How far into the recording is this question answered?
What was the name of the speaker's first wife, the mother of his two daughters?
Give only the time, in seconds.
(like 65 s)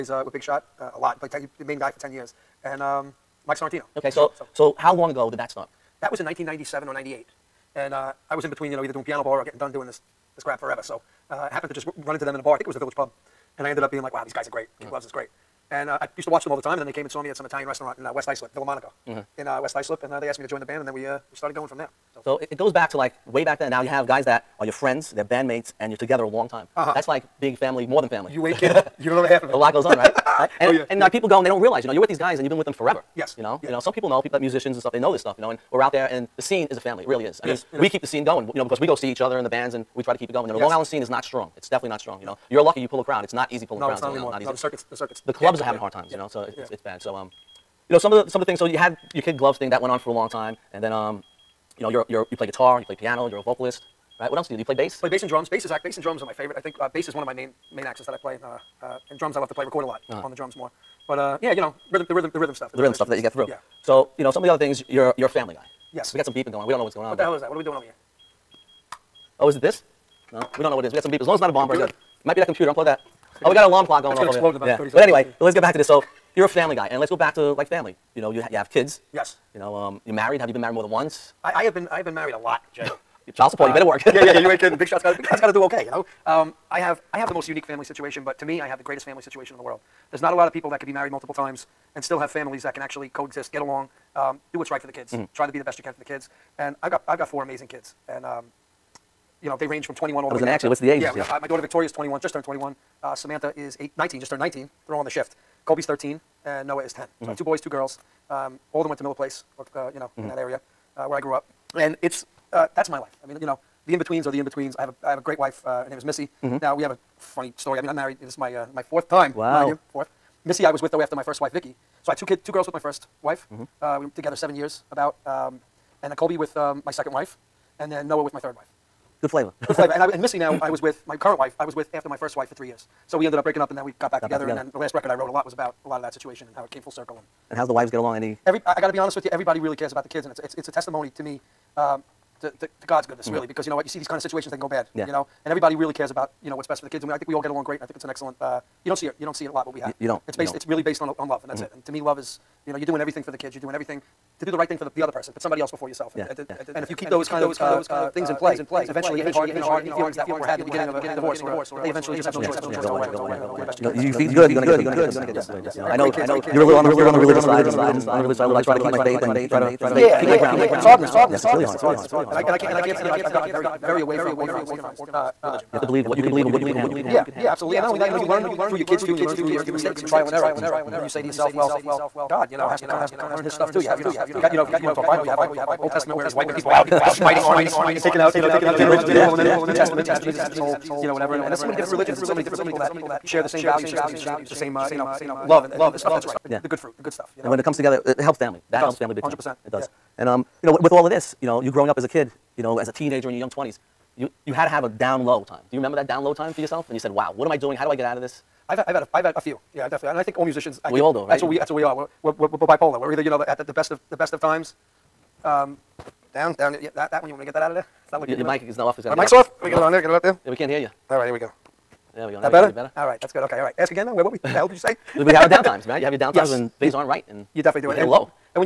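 121 s.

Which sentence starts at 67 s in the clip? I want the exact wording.
What are we doing over here?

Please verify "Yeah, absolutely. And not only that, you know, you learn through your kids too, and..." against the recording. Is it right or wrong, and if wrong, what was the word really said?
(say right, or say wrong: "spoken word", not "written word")
right.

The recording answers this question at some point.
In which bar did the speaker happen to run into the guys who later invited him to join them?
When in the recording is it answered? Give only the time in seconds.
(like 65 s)
12 s.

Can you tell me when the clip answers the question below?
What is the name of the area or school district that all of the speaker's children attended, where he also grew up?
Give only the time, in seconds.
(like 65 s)
109 s.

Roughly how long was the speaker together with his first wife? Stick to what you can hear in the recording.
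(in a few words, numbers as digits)
7 years.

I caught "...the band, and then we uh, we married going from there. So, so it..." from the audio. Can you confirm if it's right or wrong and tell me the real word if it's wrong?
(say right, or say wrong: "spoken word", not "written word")
wrong: "started", not "married".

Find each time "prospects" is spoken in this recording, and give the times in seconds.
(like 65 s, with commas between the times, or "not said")
not said.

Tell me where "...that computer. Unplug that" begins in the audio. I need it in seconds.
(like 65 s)
72 s.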